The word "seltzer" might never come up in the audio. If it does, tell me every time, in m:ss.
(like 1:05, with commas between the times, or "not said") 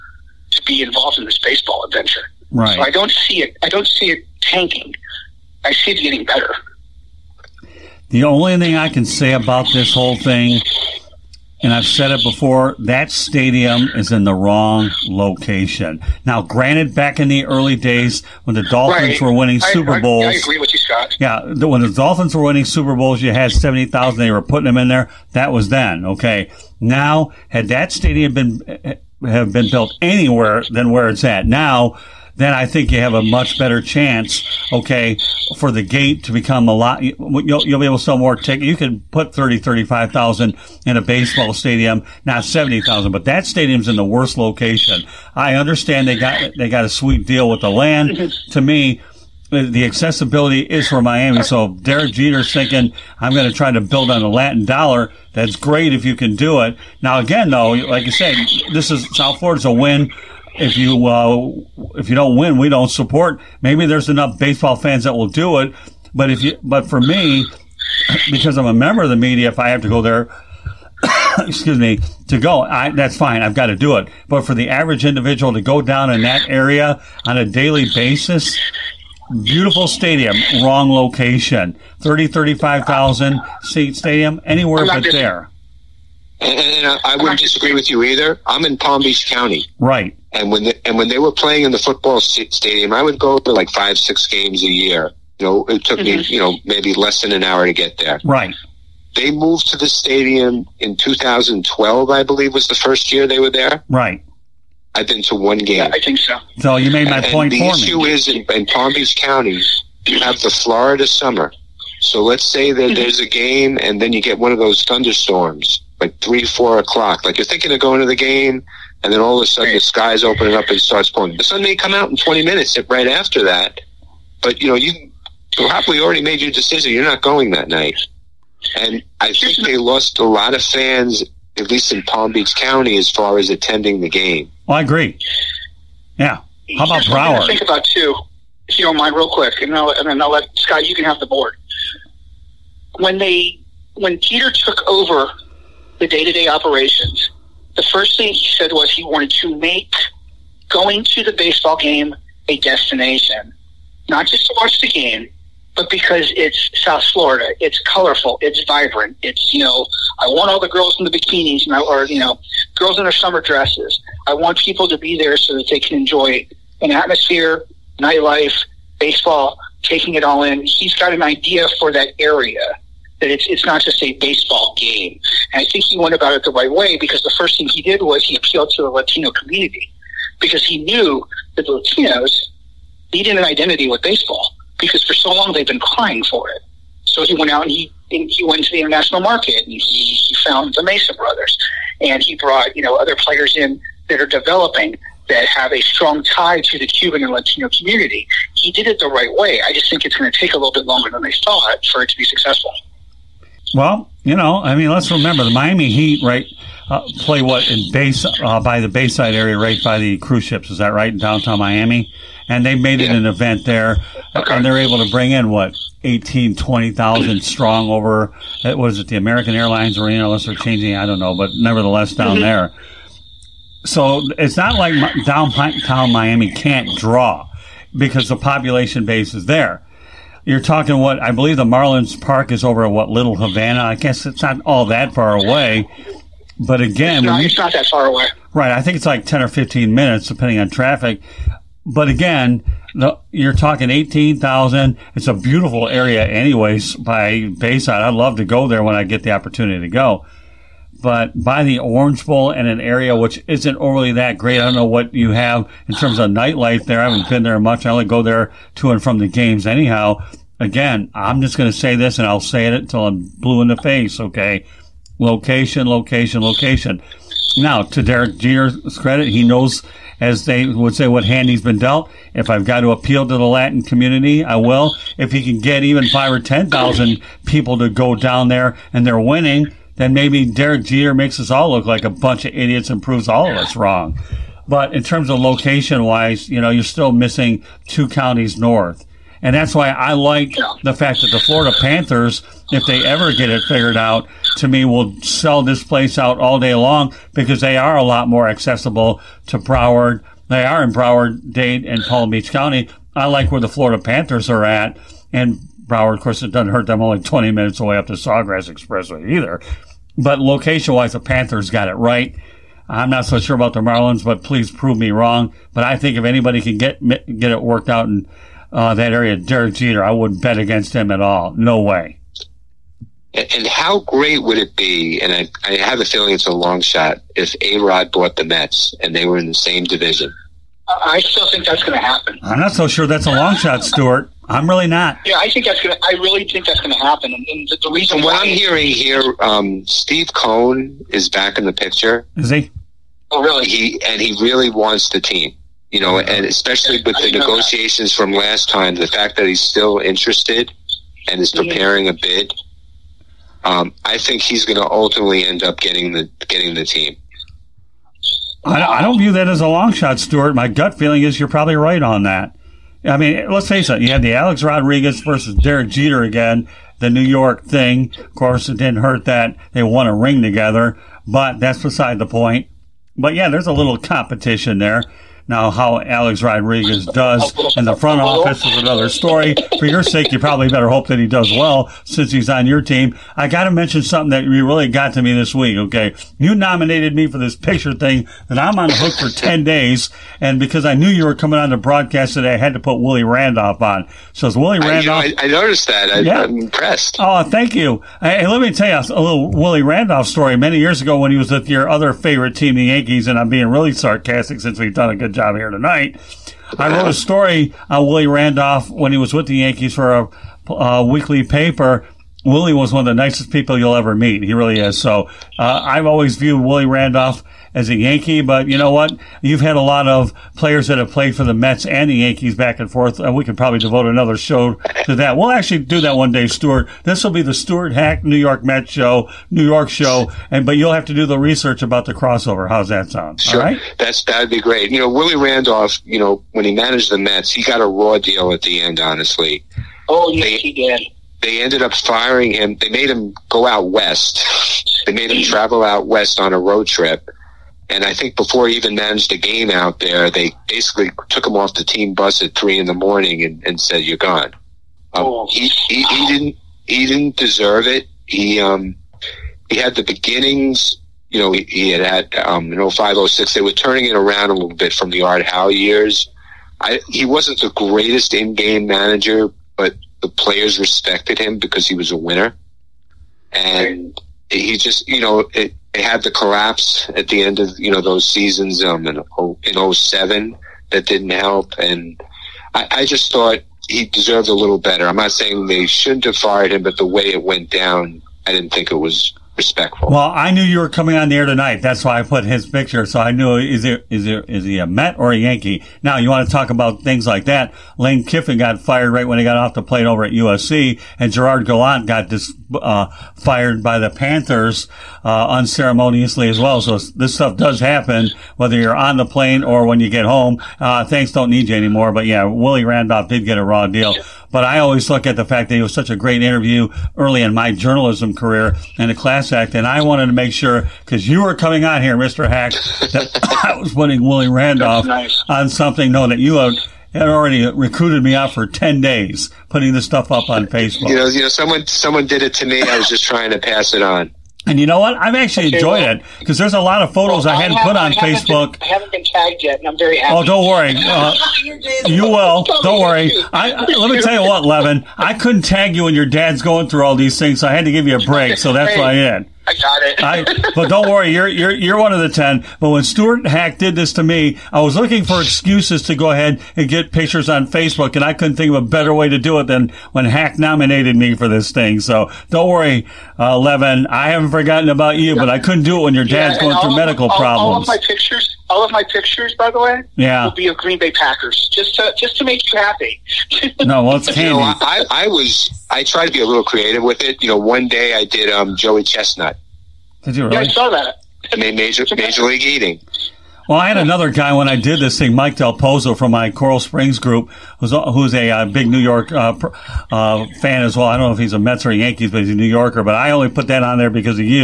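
not said.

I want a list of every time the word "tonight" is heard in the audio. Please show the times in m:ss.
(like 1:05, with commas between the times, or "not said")
6:45, 8:11.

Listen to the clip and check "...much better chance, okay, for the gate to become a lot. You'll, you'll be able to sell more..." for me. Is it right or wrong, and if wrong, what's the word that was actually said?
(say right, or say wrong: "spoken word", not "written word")
right.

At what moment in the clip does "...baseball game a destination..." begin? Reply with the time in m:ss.
2:31.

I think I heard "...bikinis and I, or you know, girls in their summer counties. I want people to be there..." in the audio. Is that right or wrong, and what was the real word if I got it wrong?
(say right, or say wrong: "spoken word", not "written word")
wrong: "dresses", not "counties".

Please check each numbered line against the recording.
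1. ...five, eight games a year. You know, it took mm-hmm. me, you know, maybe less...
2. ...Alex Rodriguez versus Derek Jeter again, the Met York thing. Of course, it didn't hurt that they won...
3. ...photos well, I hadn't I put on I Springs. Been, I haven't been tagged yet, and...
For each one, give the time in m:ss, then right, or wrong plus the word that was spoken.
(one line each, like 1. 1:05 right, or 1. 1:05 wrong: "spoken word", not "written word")
1. 1:33 wrong: "six", not "eight"
2. 6:04 wrong: "New", not "Met"
3. 8:57 wrong: "Facebook", not "Springs".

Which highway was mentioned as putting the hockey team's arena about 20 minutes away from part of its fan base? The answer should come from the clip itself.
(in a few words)
Sawgrass Expressway.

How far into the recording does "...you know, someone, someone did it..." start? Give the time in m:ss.
8:51.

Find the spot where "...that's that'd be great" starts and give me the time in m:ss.
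7:13.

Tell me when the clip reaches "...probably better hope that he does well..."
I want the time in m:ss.
6:20.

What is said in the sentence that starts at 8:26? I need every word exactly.
So this stuff does happen, whether you're on the plane or when you get home.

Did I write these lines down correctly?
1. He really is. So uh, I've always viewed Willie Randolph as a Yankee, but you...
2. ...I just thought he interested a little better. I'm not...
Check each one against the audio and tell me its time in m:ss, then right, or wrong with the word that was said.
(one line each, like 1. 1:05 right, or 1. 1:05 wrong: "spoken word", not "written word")
1. 6:54 right
2. 8:02 wrong: "deserved", not "interested".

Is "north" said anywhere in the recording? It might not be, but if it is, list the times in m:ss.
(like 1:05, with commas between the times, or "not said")
4:48.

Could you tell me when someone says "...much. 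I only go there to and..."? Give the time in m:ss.
4:17.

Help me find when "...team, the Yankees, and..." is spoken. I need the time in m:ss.
6:42.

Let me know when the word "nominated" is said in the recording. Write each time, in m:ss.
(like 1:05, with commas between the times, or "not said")
6:26, 9:20.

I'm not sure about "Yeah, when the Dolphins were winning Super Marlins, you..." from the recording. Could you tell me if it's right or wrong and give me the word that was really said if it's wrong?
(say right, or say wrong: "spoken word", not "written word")
wrong: "Bowls", not "Marlins".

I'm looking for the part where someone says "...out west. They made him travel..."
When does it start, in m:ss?
7:23.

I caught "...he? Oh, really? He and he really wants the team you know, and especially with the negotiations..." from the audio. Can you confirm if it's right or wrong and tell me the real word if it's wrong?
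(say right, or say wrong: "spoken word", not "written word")
right.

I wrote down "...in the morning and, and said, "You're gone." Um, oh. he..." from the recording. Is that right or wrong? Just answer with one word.
right.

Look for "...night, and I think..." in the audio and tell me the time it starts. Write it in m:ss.
2:07.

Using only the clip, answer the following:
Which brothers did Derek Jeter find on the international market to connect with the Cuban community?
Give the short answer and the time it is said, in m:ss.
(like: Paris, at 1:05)
the Mesa brothers, at 3:10.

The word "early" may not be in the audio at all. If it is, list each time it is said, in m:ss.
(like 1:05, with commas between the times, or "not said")
0:17, 8:37.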